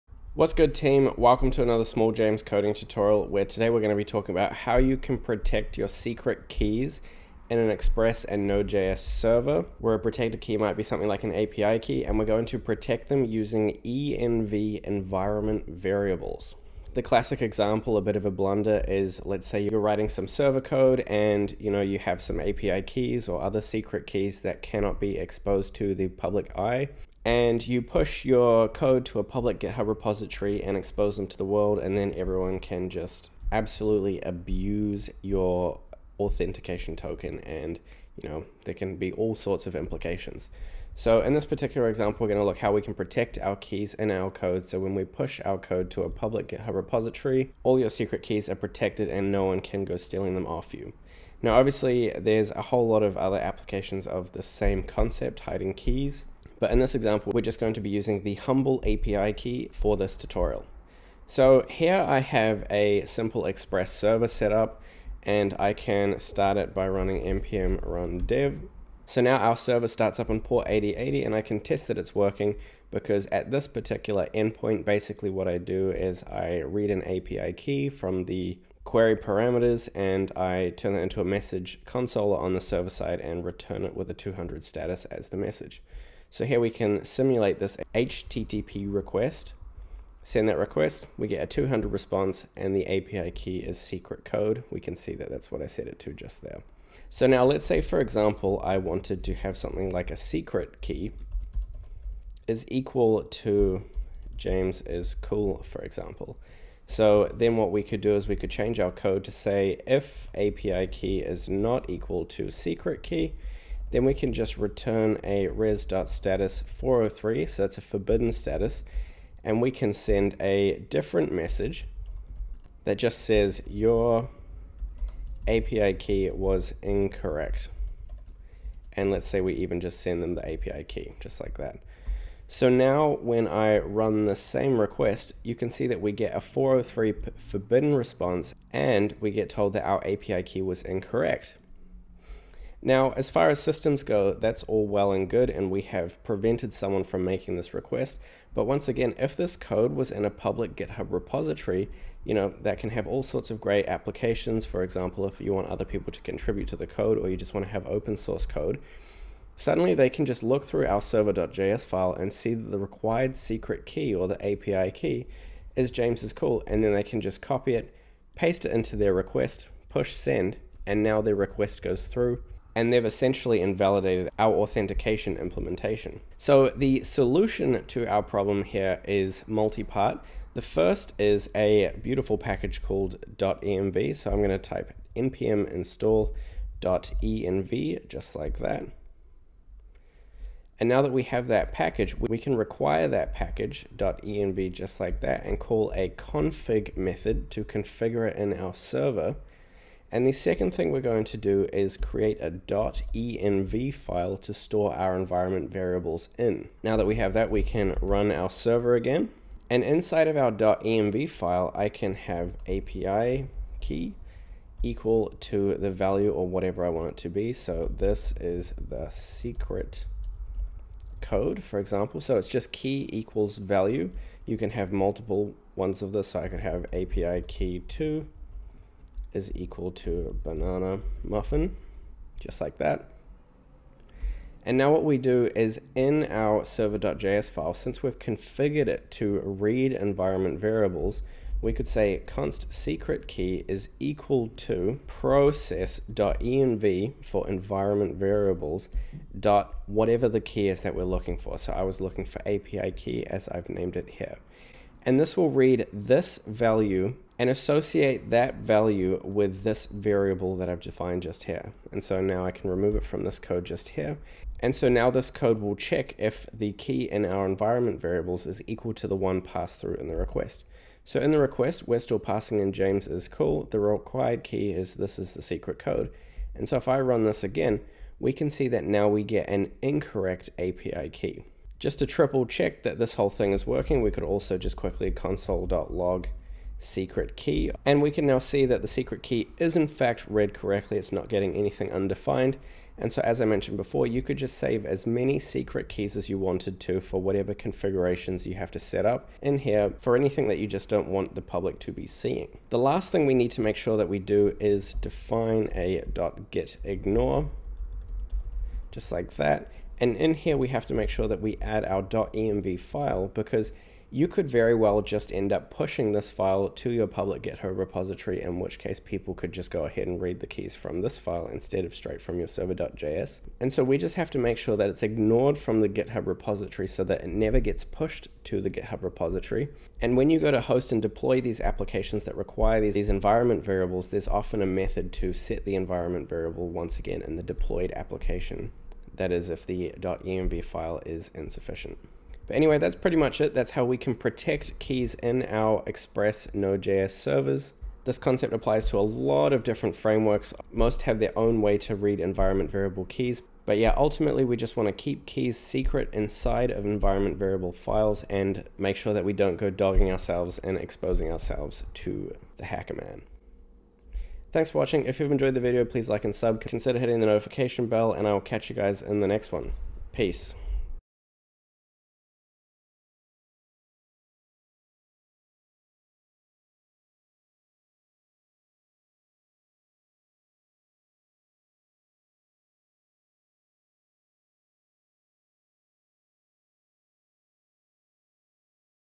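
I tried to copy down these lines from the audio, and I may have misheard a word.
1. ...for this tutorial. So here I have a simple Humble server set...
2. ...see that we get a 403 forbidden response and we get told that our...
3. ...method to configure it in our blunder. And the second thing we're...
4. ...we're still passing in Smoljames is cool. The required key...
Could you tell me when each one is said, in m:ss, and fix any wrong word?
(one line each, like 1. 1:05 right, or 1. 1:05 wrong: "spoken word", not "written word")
1. 0:59 wrong: "Express", not "Humble"
2. 2:15 right
3. 3:16 wrong: "server", not "blunder"
4. 4:31 wrong: "James", not "Smoljames".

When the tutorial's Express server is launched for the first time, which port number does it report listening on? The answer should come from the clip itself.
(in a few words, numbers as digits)
8080.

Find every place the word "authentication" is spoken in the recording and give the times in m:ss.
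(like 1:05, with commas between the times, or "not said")
0:36, 2:54.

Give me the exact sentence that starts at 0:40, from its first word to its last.
So in this particular example, we're going to look how we can protect our keys in our code.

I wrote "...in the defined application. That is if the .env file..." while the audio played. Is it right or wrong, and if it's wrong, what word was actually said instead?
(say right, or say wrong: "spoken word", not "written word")
wrong: "deployed", not "defined".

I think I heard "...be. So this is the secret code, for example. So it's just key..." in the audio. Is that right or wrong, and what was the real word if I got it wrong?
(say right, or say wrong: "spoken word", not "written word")
right.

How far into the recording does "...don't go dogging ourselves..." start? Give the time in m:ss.
5:59.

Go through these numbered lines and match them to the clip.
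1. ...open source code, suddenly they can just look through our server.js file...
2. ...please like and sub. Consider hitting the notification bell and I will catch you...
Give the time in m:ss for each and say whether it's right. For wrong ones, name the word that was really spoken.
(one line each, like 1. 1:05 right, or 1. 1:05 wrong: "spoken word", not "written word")
1. 2:37 right
2. 6:05 right.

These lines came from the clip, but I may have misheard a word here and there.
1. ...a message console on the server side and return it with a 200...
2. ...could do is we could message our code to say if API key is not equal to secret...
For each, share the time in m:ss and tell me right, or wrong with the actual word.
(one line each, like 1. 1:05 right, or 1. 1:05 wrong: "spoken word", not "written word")
1. 1:21 right
2. 1:47 wrong: "change", not "message".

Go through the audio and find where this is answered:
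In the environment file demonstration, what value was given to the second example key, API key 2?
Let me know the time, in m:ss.
3:50.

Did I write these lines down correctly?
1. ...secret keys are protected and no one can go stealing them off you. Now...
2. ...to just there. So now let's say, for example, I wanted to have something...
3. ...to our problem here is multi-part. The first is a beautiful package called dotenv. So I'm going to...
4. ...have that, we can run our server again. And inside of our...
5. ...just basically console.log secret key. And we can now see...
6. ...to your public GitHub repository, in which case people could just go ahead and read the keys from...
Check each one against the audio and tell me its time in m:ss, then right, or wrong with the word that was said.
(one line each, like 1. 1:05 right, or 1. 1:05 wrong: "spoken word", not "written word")
1. 0:47 right
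2. 1:35 right
3. 2:57 right
4. 3:27 right
5. 4:44 wrong: "quickly", not "basically"
6. 5:16 right.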